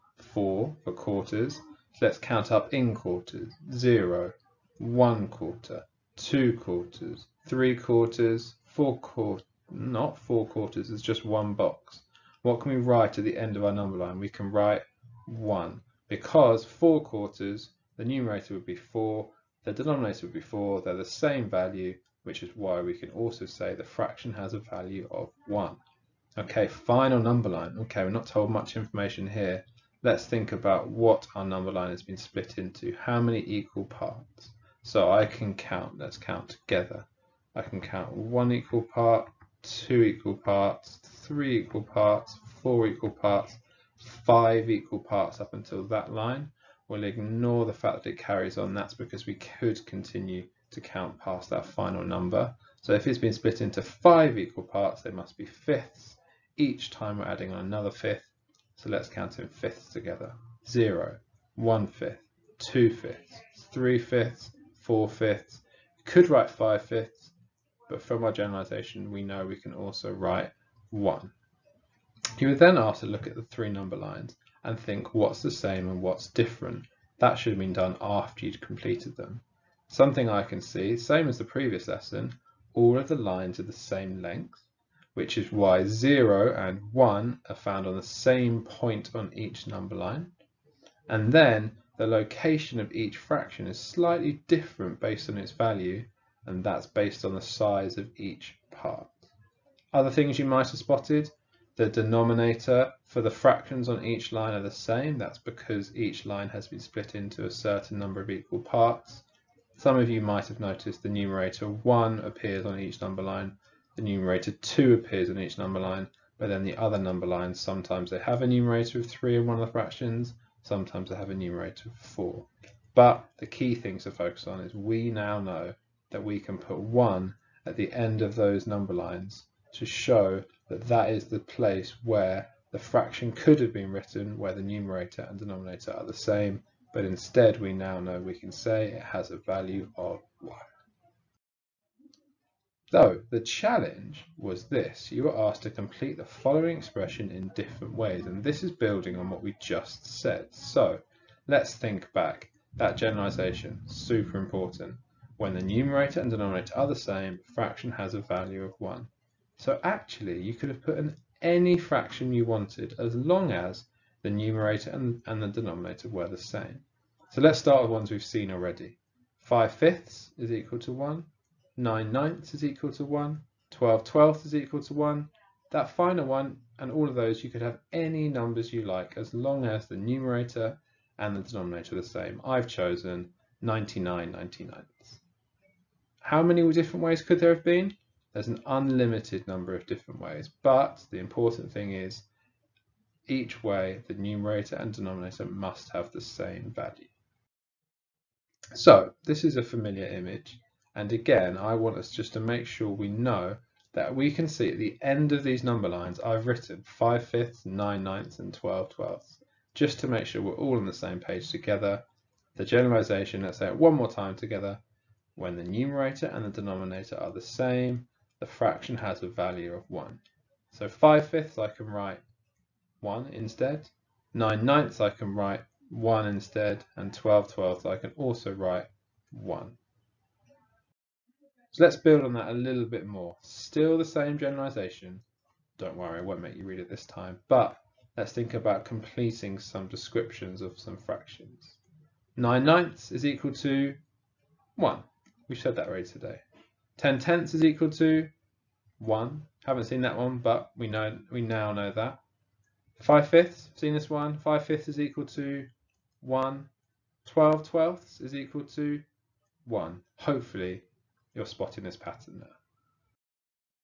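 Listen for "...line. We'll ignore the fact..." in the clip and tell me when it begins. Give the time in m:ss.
0:46.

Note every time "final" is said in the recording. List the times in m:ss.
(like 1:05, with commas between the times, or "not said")
0:26, 0:51, 2:55.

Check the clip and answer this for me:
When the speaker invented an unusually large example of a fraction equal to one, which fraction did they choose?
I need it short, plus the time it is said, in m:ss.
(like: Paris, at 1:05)
99 ninety-ninths, at 3:03.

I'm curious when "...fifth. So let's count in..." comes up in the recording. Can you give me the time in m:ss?
0:57.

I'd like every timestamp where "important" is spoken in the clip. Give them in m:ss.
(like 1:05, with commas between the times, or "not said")
2:34, 3:11.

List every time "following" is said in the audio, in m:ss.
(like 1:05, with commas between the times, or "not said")
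2:26.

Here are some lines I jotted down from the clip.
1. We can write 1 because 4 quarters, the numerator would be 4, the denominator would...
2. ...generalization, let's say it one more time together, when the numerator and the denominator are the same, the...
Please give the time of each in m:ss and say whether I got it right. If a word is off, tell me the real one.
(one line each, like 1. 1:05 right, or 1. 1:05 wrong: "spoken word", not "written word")
1. 0:14 right
2. 3:32 right.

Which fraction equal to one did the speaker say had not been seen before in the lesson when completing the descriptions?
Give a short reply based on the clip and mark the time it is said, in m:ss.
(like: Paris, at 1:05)
10 tenths, at 4:06.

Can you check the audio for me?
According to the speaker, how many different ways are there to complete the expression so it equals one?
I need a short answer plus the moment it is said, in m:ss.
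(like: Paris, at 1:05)
Unlimited, at 3:08.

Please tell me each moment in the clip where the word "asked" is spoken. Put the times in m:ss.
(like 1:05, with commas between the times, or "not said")
1:12, 2:25.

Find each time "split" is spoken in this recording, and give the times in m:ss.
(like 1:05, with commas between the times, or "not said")
0:32, 0:53, 1:46.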